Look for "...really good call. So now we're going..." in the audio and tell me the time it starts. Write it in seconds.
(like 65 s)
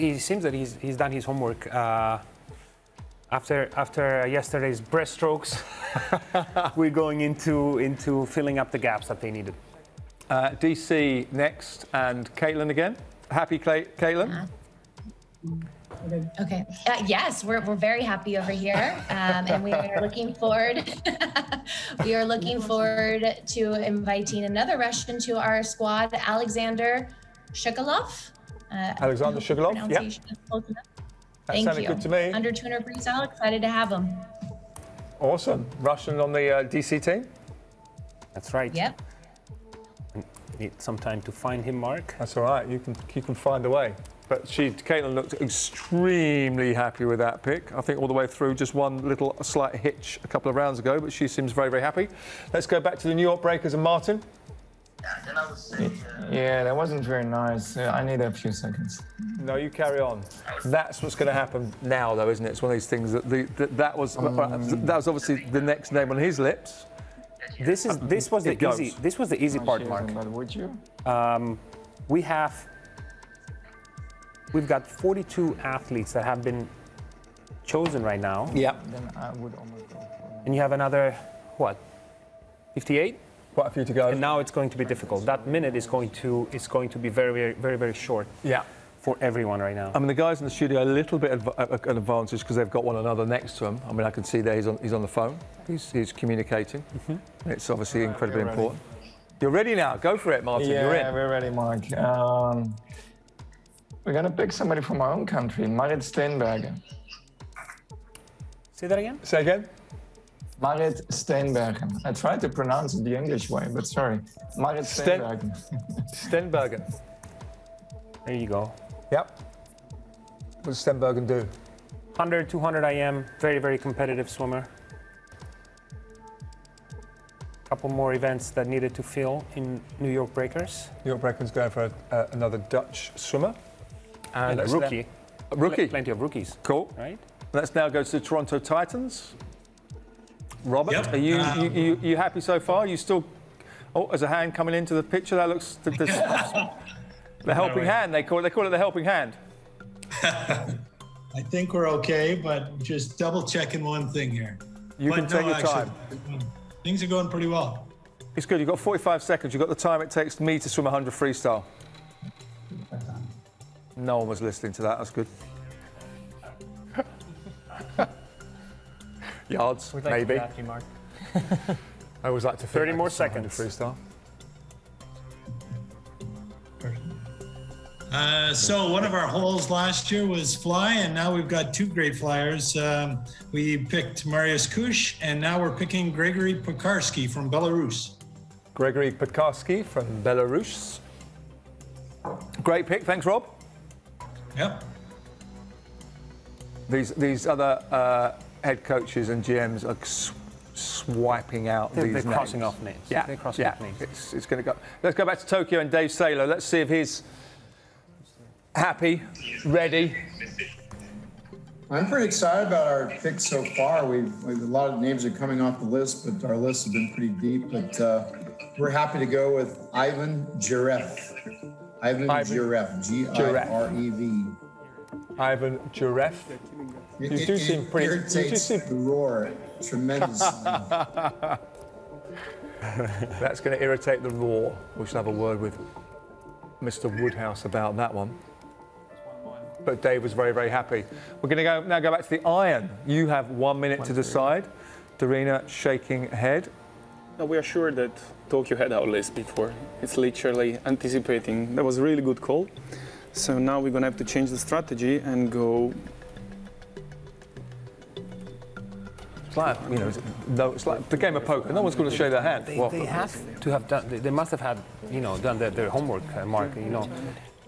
252 s.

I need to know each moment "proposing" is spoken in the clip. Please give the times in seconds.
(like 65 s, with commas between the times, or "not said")
not said.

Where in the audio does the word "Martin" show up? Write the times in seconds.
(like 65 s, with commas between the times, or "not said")
53 s, 100 s.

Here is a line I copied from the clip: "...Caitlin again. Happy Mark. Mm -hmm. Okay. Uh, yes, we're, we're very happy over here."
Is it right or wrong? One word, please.
wrong.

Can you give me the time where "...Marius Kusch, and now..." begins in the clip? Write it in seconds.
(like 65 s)
184 s.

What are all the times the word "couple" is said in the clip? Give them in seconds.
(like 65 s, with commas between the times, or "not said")
50 s, 127 s.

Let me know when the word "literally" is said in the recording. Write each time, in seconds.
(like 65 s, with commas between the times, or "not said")
250 s.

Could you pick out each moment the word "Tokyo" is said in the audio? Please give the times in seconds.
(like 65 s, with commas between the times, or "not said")
205 s, 248 s.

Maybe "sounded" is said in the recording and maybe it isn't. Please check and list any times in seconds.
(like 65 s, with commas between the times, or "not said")
31 s.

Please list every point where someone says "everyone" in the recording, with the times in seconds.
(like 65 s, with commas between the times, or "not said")
89 s.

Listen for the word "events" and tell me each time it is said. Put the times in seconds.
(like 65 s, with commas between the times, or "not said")
128 s.